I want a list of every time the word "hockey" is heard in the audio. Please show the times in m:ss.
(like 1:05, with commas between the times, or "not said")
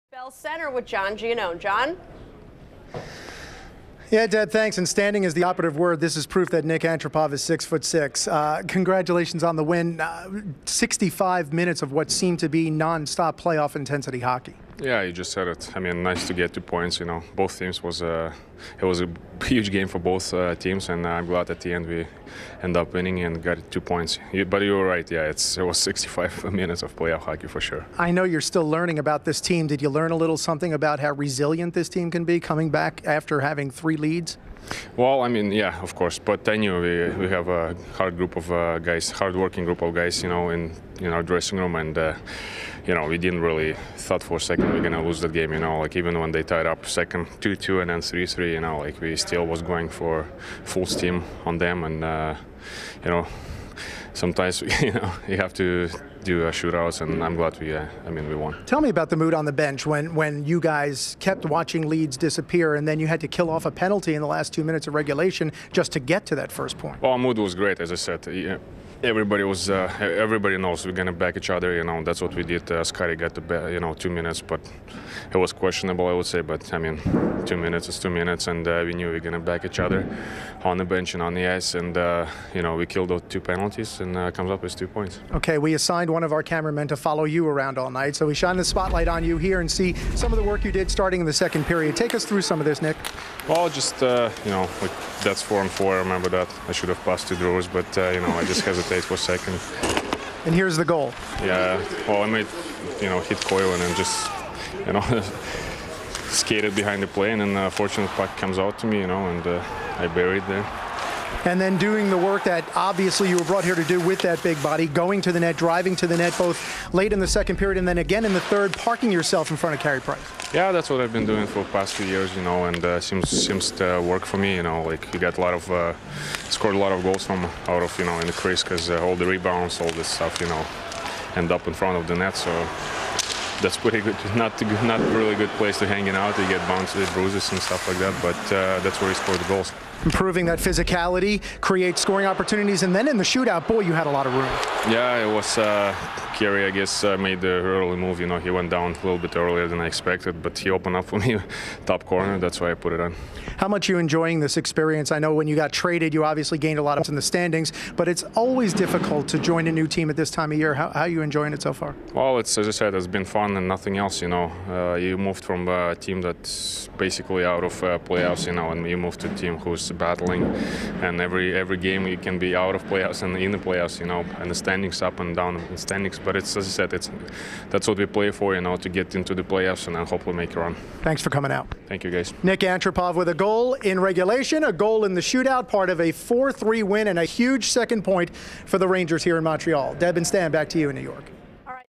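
0:14, 0:27.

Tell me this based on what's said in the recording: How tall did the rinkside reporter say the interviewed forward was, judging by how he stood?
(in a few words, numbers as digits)
6 foot 6.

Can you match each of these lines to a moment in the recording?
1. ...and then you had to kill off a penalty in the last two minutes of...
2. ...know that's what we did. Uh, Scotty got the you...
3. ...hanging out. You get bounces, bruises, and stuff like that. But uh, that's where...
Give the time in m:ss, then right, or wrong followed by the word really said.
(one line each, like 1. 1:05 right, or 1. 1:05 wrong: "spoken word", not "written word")
1. 1:02 right
2. 1:11 right
3. 2:15 right.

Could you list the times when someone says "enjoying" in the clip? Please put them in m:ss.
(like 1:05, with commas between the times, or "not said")
2:33, 2:41.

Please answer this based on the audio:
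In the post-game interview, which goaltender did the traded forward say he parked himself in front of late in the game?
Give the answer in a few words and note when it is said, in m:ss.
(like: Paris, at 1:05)
Carey Price, at 1:59.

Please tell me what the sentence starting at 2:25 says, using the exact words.
Uh, Carey, I guess, uh, made the early move.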